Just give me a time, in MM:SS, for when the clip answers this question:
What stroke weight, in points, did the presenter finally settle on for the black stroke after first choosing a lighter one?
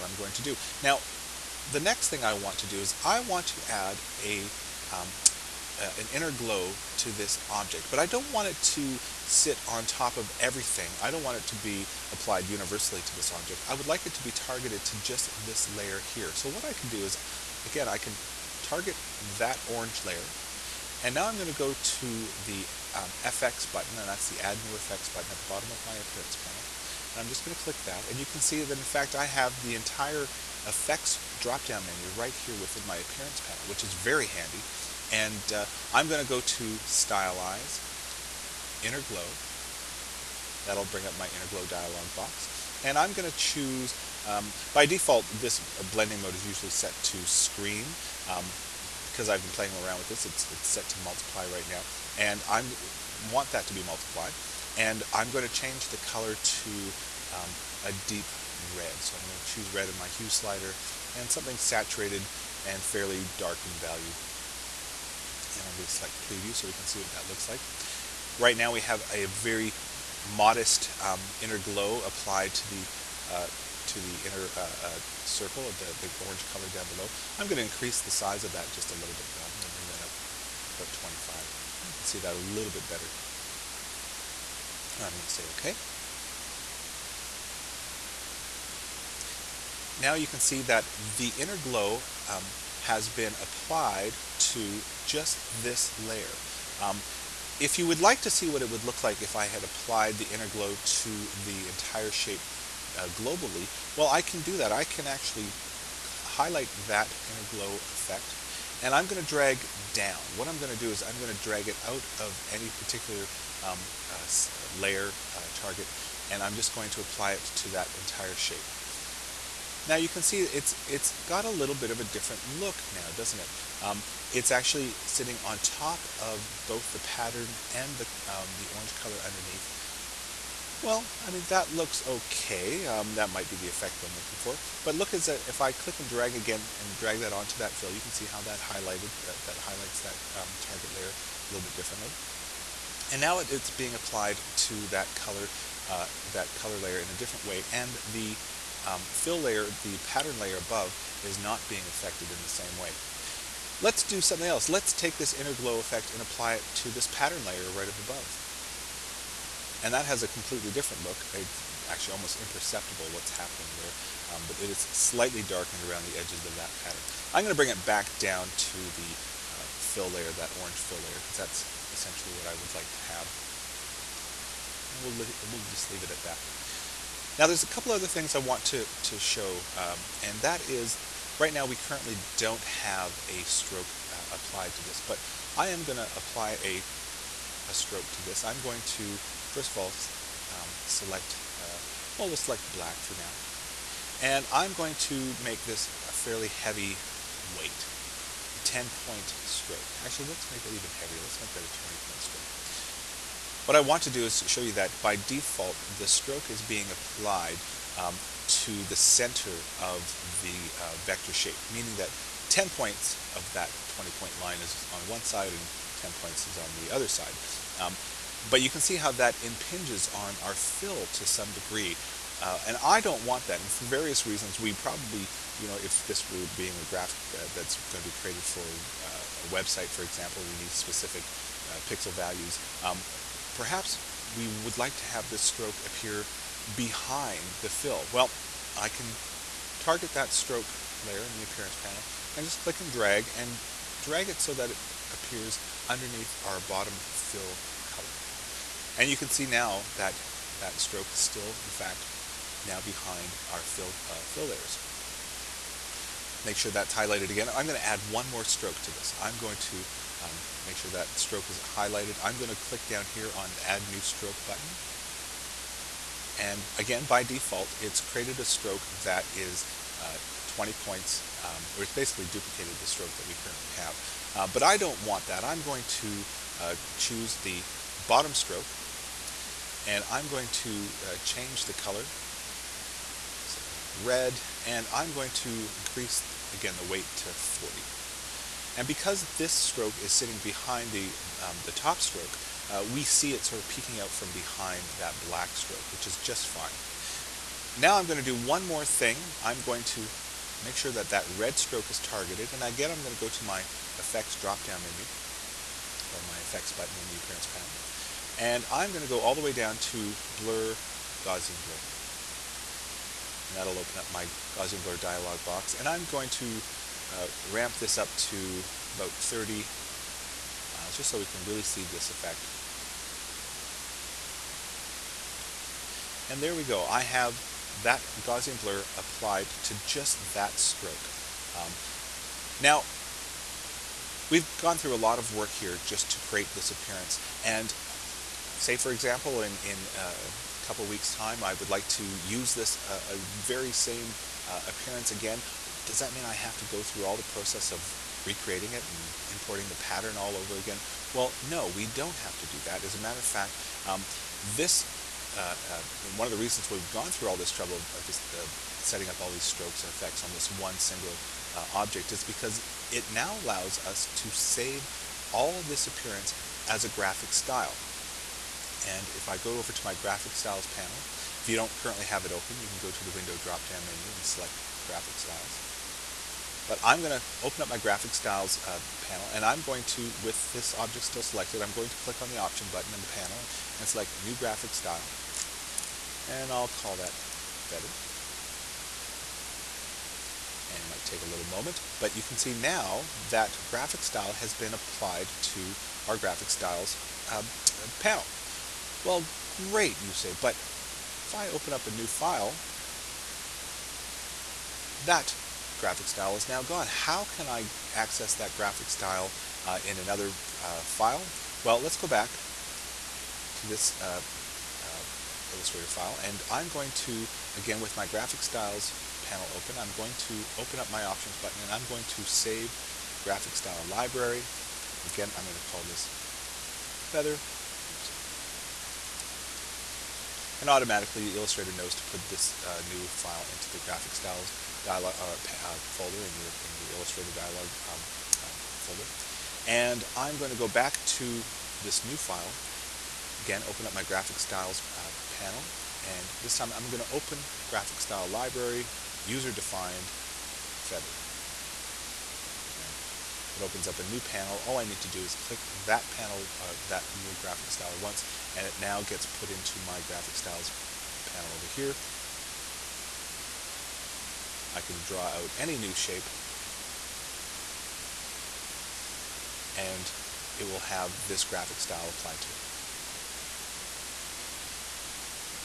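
03:21.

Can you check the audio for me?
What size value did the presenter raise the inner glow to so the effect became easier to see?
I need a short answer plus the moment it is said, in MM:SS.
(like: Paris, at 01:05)
25, at 01:20.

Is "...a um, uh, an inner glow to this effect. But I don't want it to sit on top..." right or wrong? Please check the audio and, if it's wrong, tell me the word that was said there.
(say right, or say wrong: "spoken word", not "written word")
wrong: "object", not "effect".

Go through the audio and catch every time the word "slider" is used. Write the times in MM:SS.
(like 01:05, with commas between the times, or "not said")
01:00.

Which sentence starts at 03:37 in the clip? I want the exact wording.
Um, but you can see how that impinges on our fill to some degree.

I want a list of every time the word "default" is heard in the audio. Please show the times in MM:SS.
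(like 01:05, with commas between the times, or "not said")
00:44, 03:25, 04:27.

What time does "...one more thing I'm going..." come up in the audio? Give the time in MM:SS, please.
04:58.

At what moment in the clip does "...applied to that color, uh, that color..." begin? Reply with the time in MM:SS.
02:23.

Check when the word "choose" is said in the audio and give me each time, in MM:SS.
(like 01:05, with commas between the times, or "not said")
00:43, 00:59, 04:36.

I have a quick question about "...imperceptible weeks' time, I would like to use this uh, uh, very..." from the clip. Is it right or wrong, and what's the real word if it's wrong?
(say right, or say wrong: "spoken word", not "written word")
wrong: "couple", not "imperceptible".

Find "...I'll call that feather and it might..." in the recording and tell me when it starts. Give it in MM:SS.
06:26.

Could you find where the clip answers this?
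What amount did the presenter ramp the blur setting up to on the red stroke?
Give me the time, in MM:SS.
05:19.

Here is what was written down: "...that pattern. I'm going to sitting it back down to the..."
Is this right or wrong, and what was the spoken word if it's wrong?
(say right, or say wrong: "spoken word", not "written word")
wrong: "bring", not "sitting".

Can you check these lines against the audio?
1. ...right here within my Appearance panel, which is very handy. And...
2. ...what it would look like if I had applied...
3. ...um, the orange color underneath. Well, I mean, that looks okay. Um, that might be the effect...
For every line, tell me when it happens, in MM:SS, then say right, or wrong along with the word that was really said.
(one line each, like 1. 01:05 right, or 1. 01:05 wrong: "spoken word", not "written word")
1. 00:32 right
2. 01:38 right
3. 02:08 right.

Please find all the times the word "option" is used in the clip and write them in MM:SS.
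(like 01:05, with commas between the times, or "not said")
06:22, 07:01.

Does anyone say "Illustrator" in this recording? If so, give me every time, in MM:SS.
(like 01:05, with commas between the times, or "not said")
06:55, 07:11, 07:16.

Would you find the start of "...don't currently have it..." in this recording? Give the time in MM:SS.
06:11.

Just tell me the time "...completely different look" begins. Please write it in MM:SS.
02:40.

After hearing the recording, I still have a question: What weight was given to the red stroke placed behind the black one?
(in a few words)
40.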